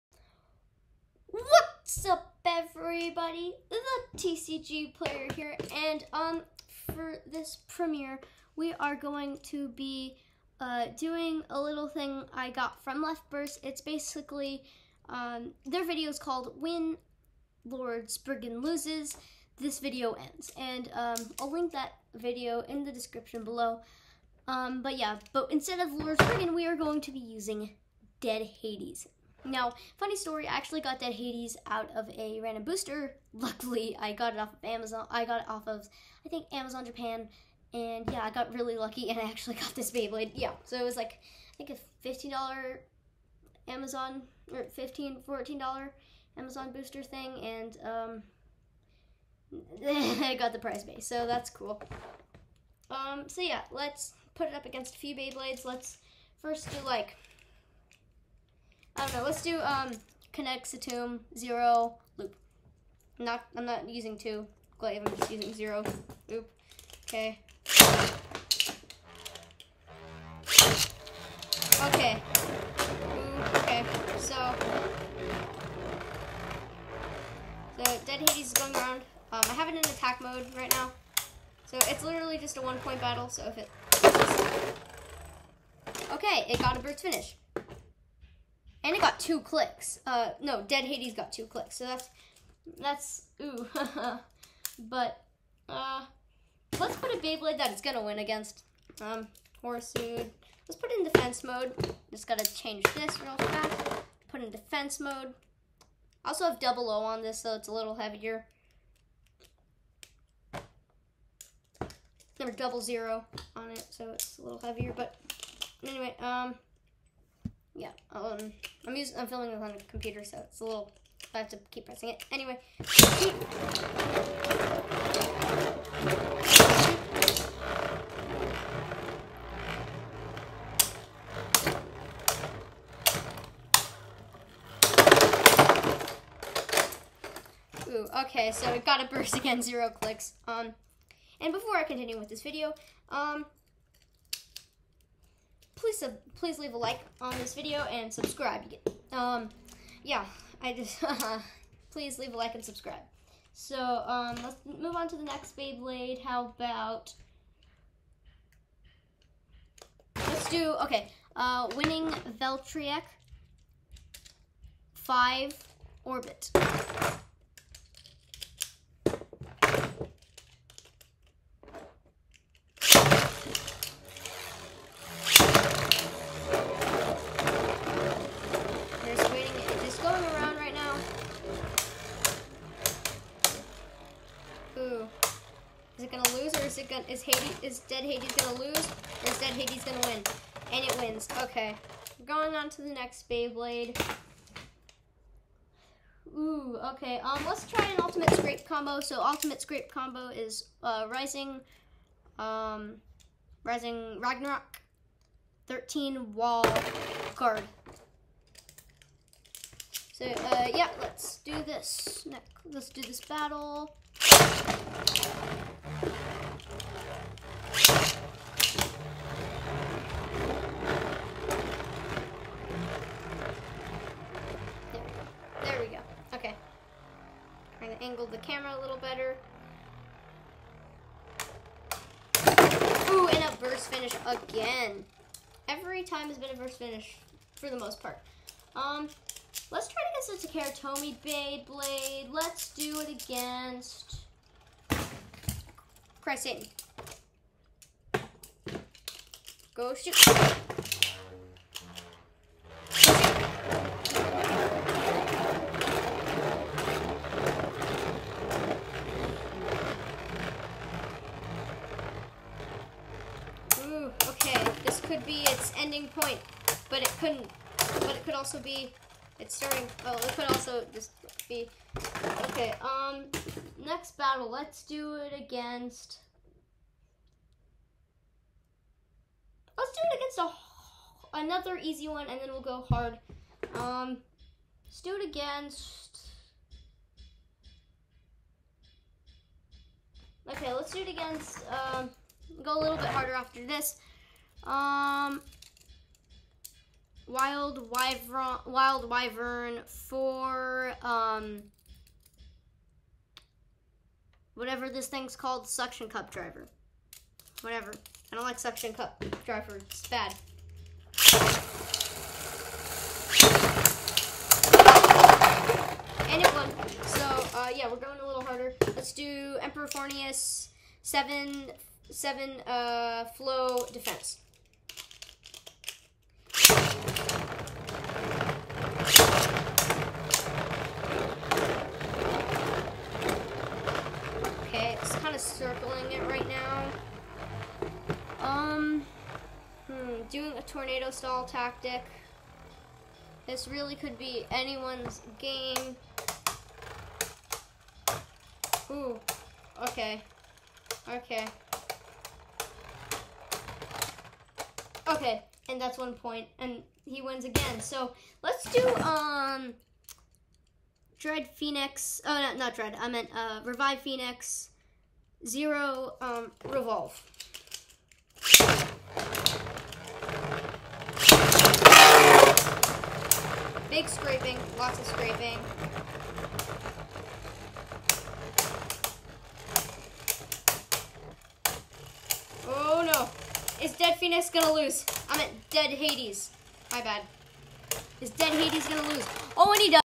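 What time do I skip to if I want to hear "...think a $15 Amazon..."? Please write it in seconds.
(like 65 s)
41 s.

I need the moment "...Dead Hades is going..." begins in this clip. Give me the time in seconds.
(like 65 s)
78 s.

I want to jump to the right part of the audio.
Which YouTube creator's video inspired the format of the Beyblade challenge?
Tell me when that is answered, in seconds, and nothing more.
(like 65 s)
13 s.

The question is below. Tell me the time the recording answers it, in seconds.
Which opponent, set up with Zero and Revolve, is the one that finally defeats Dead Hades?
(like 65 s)
363 s.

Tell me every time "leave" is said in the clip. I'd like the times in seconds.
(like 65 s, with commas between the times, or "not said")
146 s, 152 s.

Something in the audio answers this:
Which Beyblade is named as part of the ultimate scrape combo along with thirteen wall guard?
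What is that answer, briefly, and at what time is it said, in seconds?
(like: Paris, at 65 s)
Rising Ragnarok, at 203 s.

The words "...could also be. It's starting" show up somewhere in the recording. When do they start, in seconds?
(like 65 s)
268 s.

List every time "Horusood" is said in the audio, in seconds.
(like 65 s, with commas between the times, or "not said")
99 s.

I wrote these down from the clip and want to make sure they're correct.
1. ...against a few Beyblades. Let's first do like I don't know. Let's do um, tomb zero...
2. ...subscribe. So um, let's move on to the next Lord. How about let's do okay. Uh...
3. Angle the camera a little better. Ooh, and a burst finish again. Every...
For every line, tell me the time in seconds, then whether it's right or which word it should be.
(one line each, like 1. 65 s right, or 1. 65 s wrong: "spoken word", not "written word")
1. 54 s right
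2. 152 s wrong: "Beyblade", not "Lord"
3. 228 s right.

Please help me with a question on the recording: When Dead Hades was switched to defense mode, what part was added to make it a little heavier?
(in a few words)
double O.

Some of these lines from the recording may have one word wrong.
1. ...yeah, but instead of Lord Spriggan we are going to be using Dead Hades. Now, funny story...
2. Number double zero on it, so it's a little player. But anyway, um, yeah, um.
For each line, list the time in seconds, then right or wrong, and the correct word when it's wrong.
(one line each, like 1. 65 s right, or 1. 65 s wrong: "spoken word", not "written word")
1. 24 s right
2. 112 s wrong: "heavier", not "player".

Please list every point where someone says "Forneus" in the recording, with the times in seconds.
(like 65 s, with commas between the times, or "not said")
319 s.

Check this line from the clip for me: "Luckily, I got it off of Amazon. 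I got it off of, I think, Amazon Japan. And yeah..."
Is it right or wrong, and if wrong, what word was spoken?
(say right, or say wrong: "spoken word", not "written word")
right.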